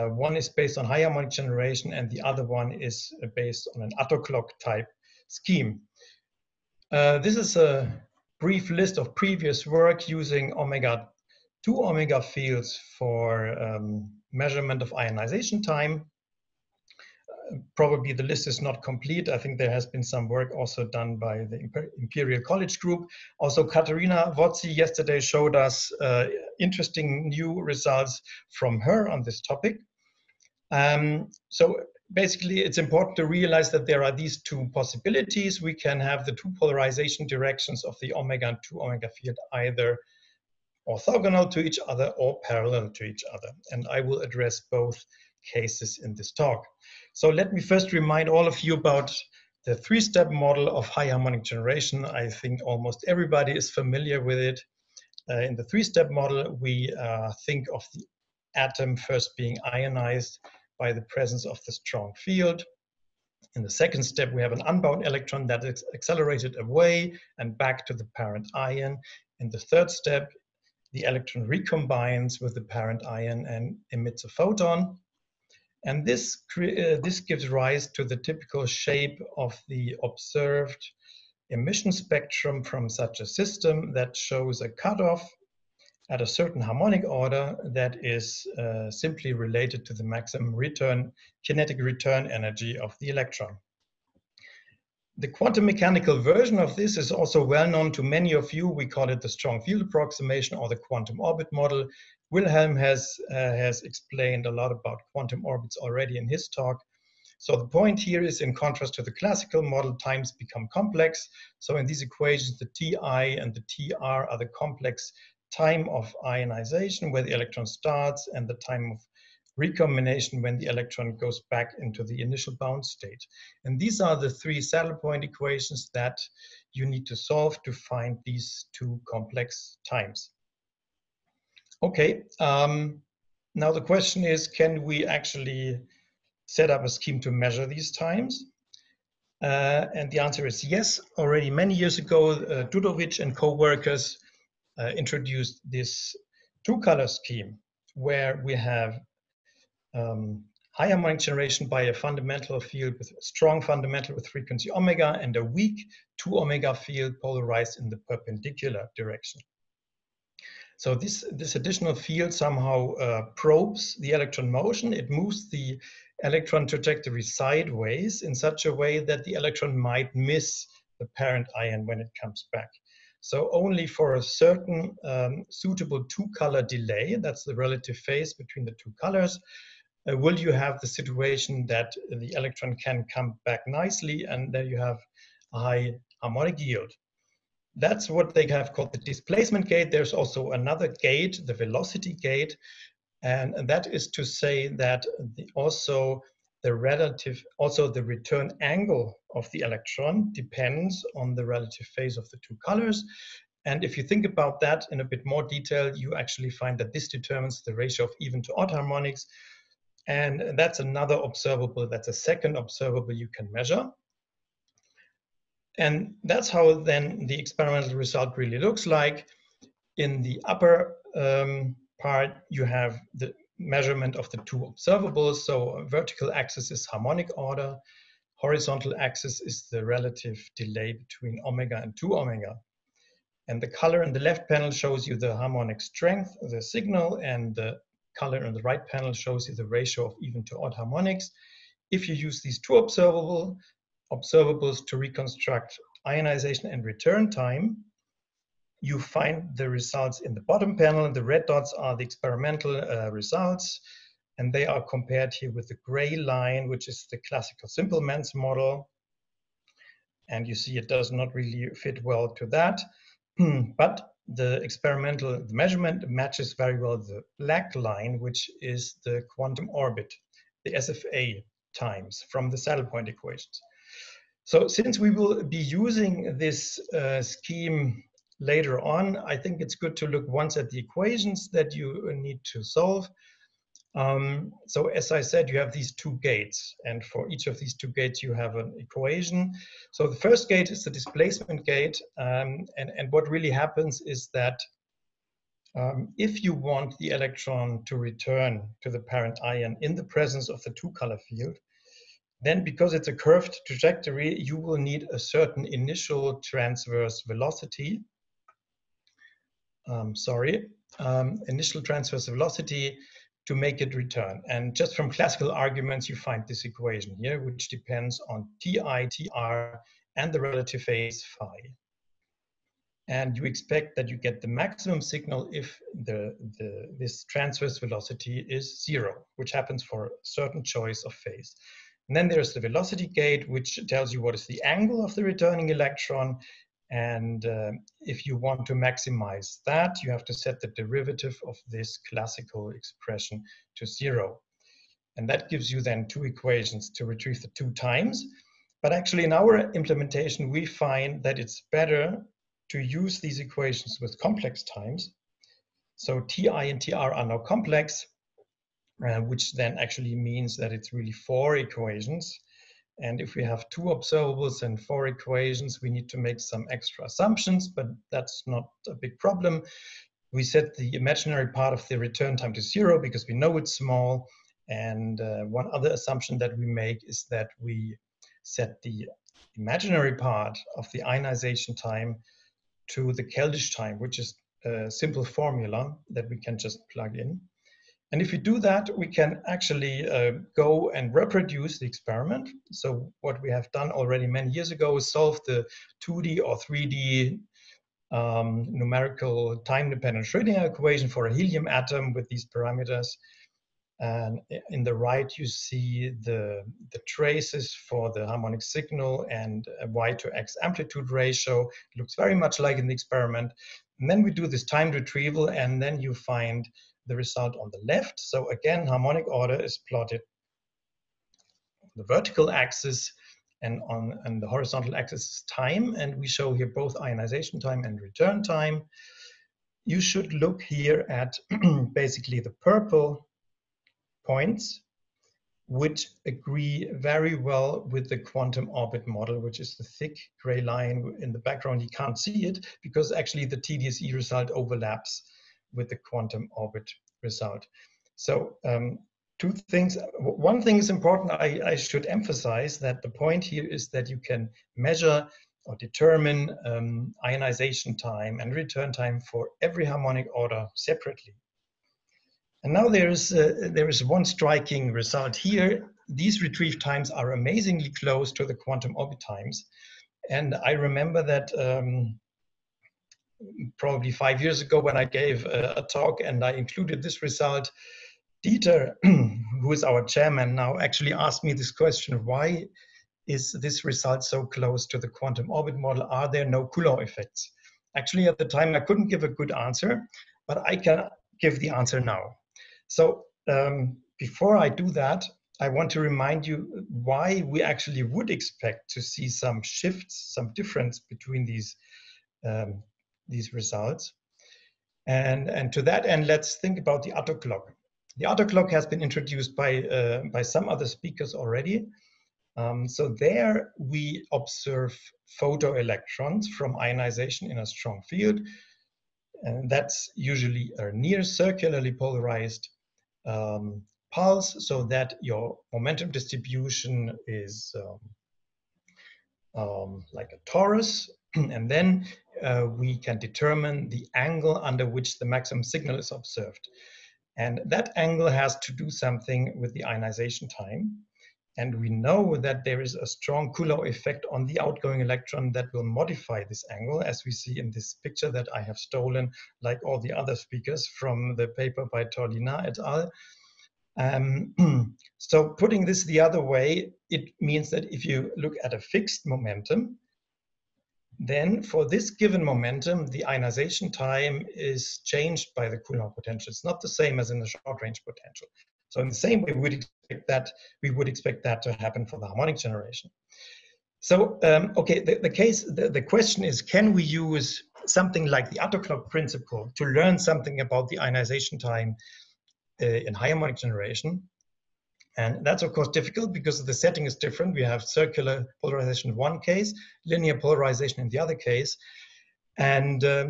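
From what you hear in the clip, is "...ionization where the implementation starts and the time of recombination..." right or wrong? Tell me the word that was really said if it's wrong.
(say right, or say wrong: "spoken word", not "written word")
wrong: "electron", not "implementation".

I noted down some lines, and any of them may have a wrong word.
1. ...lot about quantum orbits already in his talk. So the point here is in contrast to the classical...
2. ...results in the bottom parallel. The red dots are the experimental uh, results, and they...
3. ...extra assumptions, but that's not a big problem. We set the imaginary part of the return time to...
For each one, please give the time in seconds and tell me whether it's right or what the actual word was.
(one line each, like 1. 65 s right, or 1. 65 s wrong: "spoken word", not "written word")
1. 104 s right
2. 249 s wrong: "panel", not "parallel"
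3. 366 s right.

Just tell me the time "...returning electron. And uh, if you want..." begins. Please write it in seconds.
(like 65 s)
335 s.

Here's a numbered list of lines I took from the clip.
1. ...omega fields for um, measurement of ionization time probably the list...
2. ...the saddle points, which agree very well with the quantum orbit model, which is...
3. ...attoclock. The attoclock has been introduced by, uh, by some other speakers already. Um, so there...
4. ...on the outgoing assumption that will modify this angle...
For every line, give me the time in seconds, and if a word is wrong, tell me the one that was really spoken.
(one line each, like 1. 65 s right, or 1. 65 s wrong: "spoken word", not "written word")
1. 11 s right
2. 432 s wrong: "purple", not "saddle"
3. 507 s right
4. 544 s wrong: "electron", not "assumption".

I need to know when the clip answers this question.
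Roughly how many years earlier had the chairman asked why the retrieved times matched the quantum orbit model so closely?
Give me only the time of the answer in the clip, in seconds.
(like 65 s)
474 s.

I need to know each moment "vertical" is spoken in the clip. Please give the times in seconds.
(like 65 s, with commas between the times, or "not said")
225 s, 422 s.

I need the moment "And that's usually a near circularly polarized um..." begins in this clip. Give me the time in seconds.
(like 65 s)
519 s.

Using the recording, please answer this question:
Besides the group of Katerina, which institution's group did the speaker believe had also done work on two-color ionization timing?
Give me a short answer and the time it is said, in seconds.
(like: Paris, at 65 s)
Imperial College, at 21 s.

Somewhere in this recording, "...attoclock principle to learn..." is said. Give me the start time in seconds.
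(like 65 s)
578 s.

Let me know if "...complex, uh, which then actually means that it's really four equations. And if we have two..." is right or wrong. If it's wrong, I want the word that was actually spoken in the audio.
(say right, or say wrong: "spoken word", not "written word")
right.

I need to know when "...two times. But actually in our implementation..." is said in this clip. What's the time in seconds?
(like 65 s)
347 s.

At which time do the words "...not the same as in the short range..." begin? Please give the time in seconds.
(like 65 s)
566 s.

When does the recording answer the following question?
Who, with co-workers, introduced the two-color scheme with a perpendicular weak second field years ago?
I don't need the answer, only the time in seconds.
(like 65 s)
142 s.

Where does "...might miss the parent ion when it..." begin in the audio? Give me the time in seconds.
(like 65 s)
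169 s.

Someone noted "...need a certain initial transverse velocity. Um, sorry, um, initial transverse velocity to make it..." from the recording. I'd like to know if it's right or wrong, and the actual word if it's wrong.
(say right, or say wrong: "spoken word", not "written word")
right.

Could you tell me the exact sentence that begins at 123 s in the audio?
And these are the three saddle point equations that you need to solve to find these two complex times.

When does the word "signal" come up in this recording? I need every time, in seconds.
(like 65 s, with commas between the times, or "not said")
236 s, 325 s, 408 s, 535 s.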